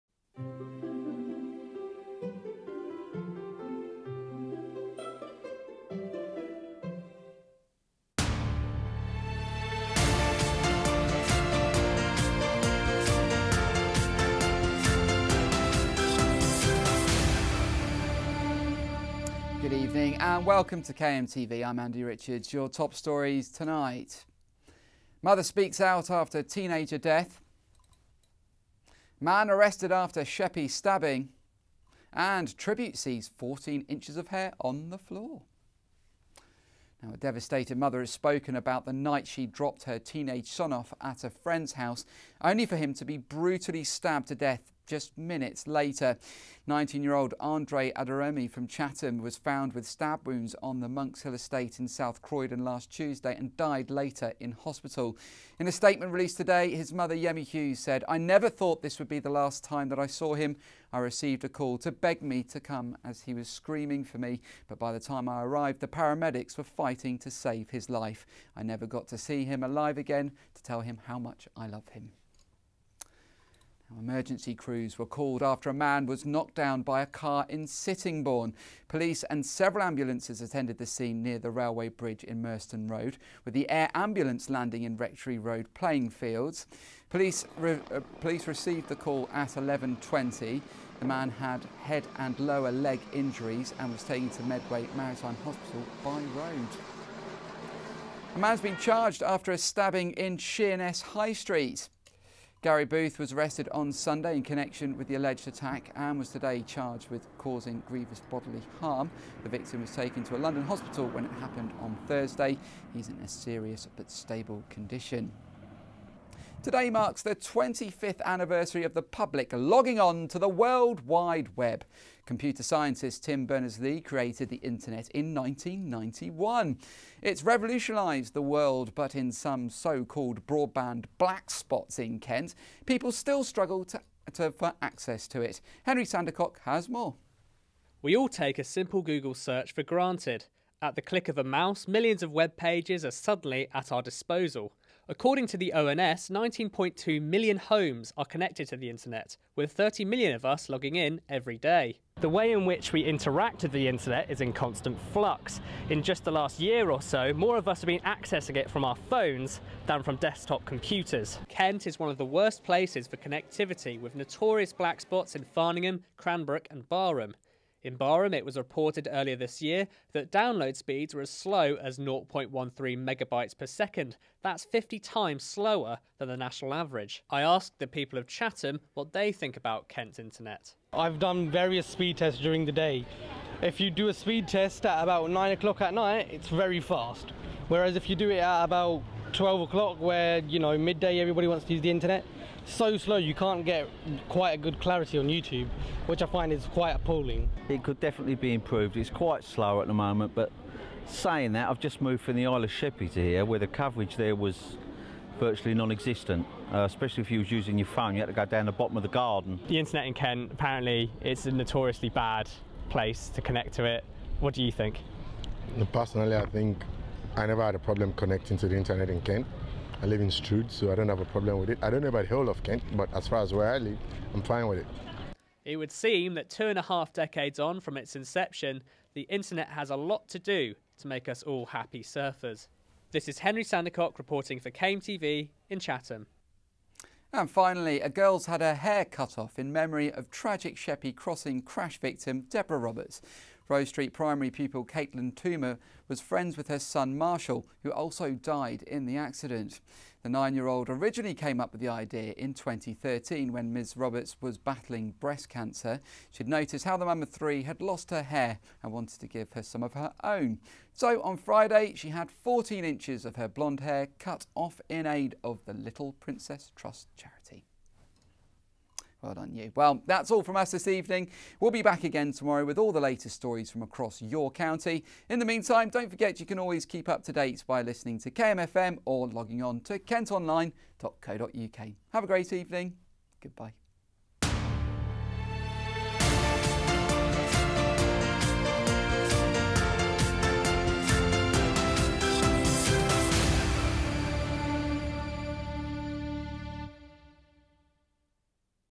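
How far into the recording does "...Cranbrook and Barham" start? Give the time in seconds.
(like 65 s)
166 s.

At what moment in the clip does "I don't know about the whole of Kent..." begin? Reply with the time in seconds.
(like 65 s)
221 s.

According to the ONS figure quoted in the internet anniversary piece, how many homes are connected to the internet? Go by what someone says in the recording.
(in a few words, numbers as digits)
19.2 million.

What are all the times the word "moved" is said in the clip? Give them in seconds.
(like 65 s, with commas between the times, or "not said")
202 s.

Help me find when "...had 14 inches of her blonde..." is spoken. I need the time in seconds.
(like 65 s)
262 s.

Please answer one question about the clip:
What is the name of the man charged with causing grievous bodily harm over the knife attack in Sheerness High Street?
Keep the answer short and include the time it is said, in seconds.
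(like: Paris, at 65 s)
Gary Booth, at 102 s.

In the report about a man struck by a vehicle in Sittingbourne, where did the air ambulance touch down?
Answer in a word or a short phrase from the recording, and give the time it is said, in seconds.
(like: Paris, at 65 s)
Rectory Road playing fields, at 84 s.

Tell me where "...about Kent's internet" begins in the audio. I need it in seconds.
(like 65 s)
179 s.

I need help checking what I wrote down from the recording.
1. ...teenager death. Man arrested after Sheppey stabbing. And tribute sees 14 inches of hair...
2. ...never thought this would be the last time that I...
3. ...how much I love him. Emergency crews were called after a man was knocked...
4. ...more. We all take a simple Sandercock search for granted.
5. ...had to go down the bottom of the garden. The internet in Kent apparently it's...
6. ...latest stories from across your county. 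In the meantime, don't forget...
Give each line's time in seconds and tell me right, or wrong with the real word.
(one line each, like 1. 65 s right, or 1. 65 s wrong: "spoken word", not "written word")
1. 26 s right
2. 58 s right
3. 71 s right
4. 136 s wrong: "Google", not "Sandercock"
5. 208 s right
6. 272 s right.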